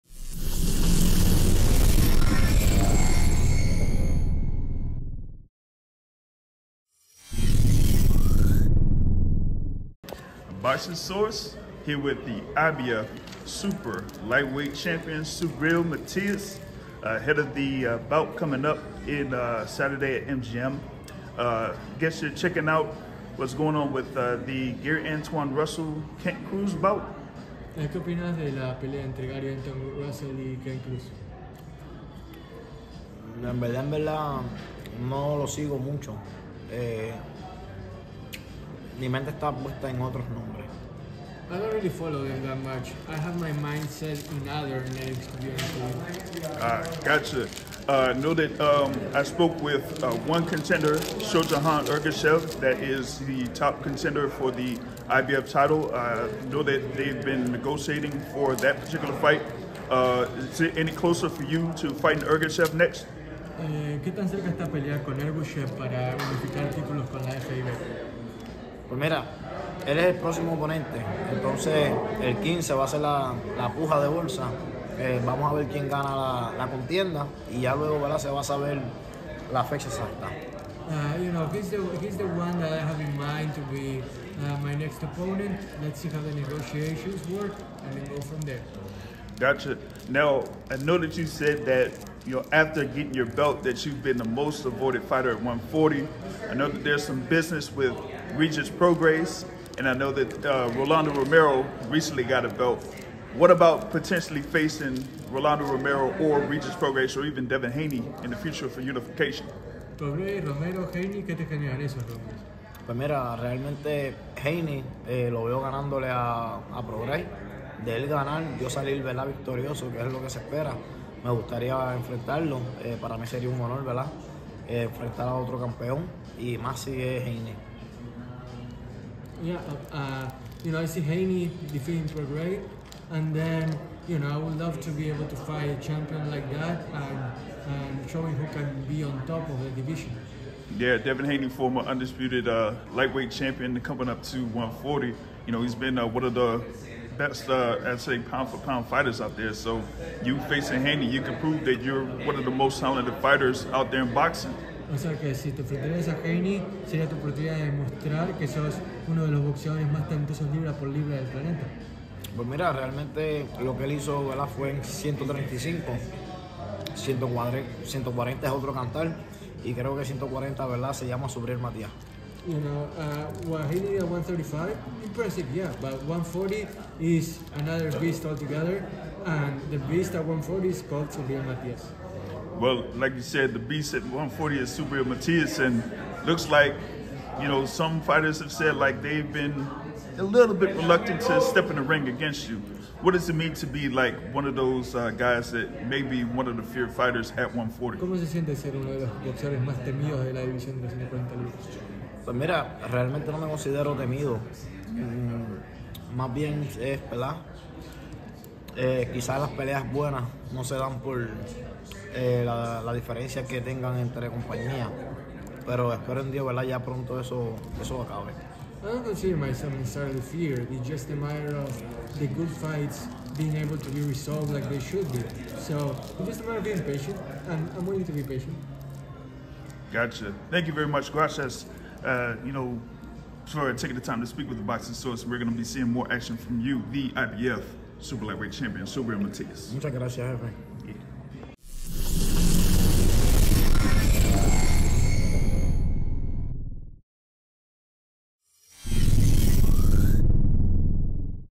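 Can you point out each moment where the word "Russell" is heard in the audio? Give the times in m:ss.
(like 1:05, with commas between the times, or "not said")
0:25, 0:30.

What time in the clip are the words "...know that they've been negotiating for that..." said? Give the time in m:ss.
0:56.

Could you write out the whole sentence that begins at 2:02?
Eh, para mí sería un honor, ¿verdad?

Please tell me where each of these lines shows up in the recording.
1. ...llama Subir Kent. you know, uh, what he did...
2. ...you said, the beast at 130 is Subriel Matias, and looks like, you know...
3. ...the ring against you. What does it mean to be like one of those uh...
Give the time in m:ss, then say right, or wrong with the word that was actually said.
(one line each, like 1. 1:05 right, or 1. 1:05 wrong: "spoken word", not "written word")
1. 2:51 wrong: "Matías", not "Kent"
2. 3:03 wrong: "140", not "130"
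3. 3:11 right.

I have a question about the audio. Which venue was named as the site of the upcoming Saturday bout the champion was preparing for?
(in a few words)
MGM.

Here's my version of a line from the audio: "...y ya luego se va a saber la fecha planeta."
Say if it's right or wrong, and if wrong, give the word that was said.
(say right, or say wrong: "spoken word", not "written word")
wrong: "exacta", not "planeta".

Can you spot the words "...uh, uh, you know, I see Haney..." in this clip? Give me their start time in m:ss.
2:09.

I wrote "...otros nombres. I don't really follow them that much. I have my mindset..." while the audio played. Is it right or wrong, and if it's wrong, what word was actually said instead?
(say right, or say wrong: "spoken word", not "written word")
right.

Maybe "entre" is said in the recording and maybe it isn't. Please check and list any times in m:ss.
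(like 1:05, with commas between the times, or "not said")
0:29, 3:33.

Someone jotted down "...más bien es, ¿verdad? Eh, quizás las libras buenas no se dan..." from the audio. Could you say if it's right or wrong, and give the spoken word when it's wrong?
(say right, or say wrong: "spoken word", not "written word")
wrong: "peleas", not "libras".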